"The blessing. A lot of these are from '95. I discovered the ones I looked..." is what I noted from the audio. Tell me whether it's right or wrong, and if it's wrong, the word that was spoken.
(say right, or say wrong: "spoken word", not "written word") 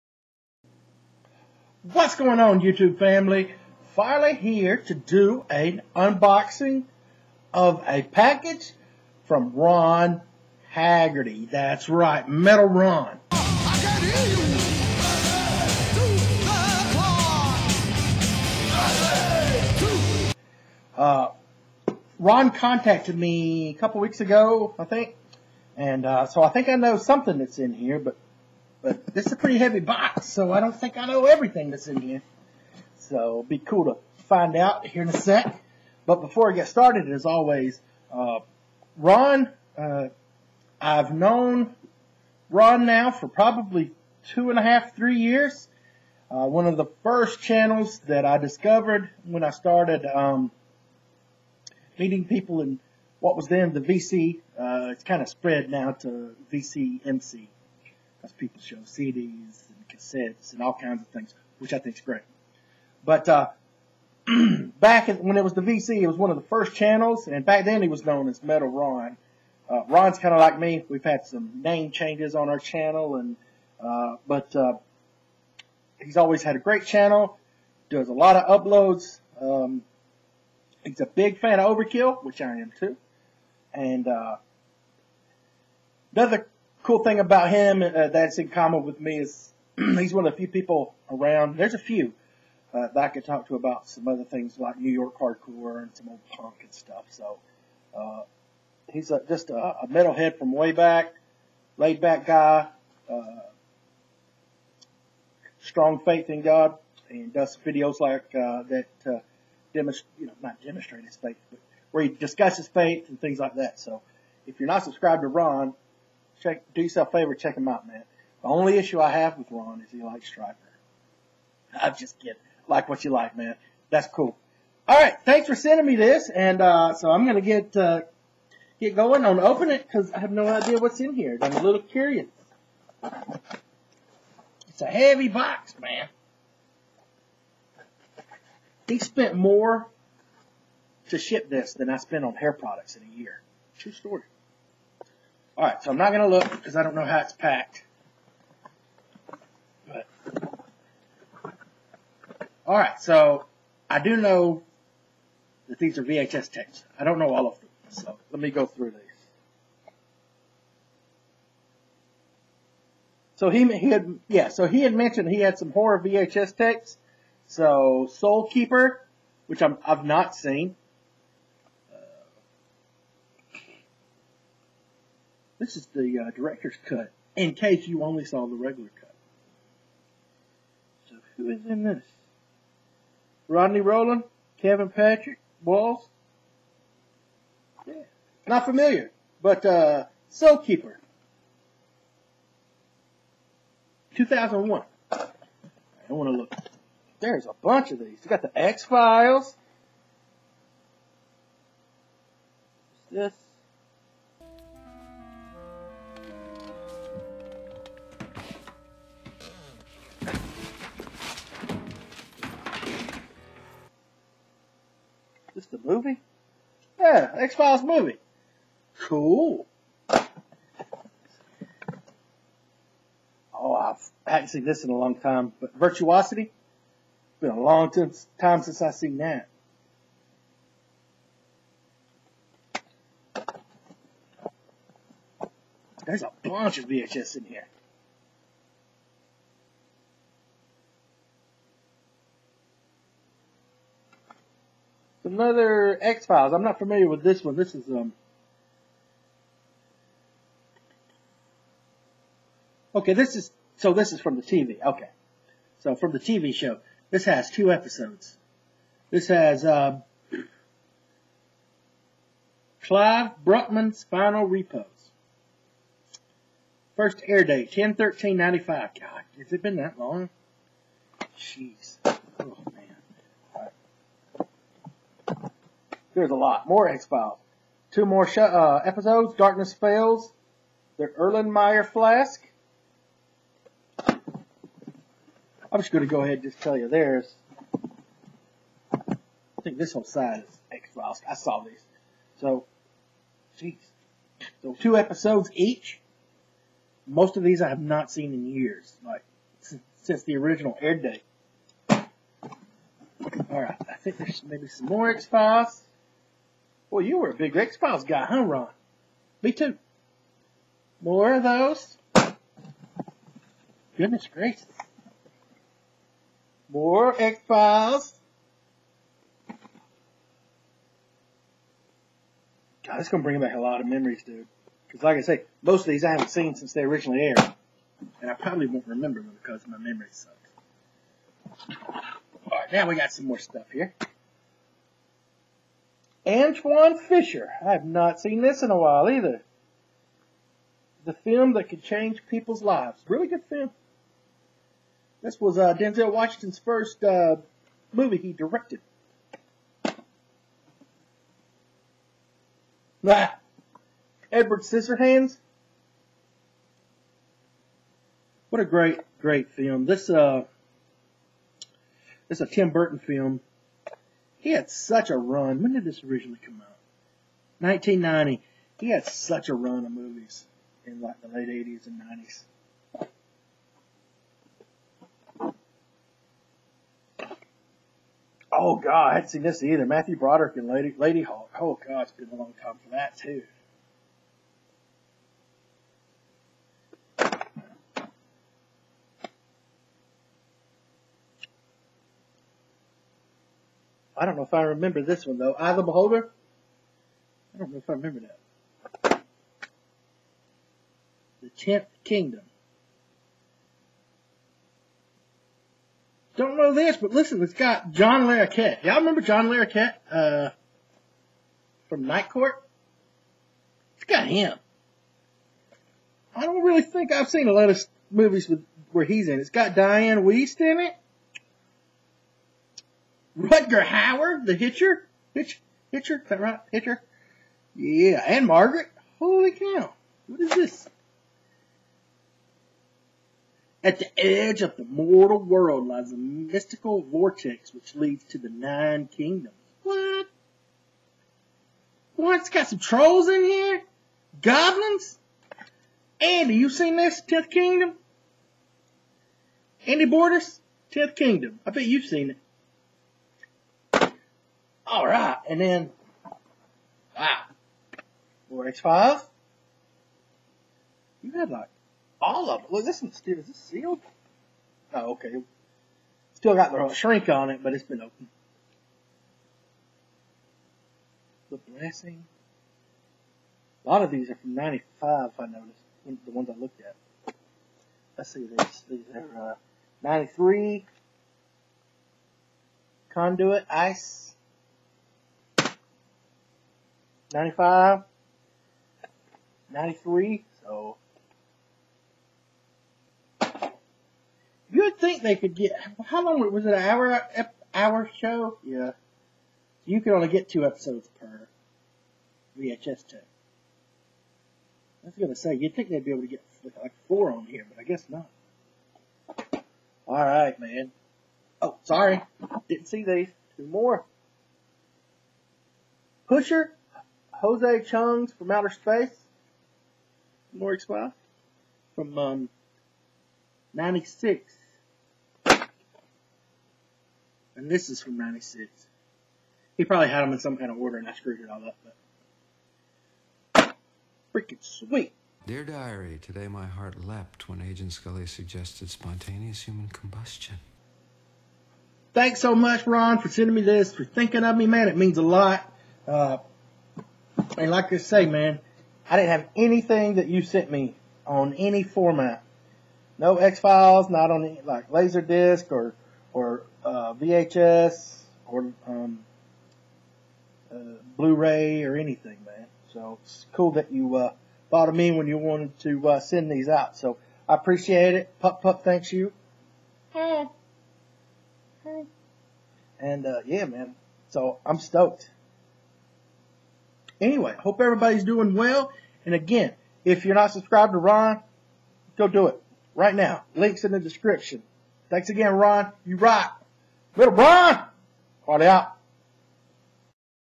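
wrong: "noticed", not "discovered".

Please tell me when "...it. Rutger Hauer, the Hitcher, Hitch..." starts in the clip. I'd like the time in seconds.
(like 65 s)
420 s.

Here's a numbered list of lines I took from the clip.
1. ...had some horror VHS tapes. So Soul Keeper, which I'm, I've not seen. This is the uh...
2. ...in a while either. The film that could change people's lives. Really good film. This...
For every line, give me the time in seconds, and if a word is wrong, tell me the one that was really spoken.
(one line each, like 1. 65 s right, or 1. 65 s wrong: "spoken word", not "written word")
1. 165 s right
2. 338 s right.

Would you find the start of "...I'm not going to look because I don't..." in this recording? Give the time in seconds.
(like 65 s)
145 s.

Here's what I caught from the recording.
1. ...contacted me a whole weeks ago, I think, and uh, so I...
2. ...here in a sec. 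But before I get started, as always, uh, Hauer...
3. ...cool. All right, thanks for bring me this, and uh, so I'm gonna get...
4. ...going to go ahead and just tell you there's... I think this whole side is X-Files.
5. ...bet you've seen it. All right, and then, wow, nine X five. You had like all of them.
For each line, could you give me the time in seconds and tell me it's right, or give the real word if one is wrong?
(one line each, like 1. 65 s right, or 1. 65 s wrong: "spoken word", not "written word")
1. 22 s wrong: "couple", not "whole"
2. 34 s wrong: "Ron", not "Hauer"
3. 124 s wrong: "sending", not "bring"
4. 285 s right
5. 451 s wrong: "four", not "nine".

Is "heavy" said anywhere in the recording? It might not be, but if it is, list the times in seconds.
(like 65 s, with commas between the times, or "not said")
29 s, 134 s.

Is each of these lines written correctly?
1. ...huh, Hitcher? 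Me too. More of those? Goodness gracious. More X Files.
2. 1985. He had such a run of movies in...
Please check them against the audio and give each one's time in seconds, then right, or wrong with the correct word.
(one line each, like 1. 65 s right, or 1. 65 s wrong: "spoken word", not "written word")
1. 308 s wrong: "Ron", not "Hitcher"
2. 367 s wrong: "1990", not "1985".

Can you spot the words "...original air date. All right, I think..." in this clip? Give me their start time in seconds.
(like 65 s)
300 s.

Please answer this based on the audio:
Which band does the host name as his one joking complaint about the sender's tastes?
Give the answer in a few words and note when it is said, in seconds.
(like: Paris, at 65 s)
Stryper, at 120 s.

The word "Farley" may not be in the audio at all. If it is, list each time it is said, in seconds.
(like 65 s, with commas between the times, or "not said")
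588 s.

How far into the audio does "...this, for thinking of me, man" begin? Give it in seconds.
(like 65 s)
543 s.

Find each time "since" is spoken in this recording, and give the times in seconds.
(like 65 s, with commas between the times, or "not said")
228 s, 300 s, 326 s.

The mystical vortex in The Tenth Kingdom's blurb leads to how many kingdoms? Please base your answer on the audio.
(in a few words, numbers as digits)
9.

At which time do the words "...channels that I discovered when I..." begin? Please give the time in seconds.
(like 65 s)
47 s.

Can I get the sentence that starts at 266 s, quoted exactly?
First air date, 10 13 95.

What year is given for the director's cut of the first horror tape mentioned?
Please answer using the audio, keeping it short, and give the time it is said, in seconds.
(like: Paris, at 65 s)
2001, at 194 s.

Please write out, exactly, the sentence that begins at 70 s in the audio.
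We've had some name changes on our channel, and uh, but uh, he's always had a great channel.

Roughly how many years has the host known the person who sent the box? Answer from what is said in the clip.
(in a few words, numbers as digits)
two and a half, three years.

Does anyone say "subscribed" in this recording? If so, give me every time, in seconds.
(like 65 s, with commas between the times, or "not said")
114 s, 580 s.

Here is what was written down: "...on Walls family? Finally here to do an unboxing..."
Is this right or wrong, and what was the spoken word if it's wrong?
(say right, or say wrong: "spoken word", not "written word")
wrong: "YouTube", not "Walls".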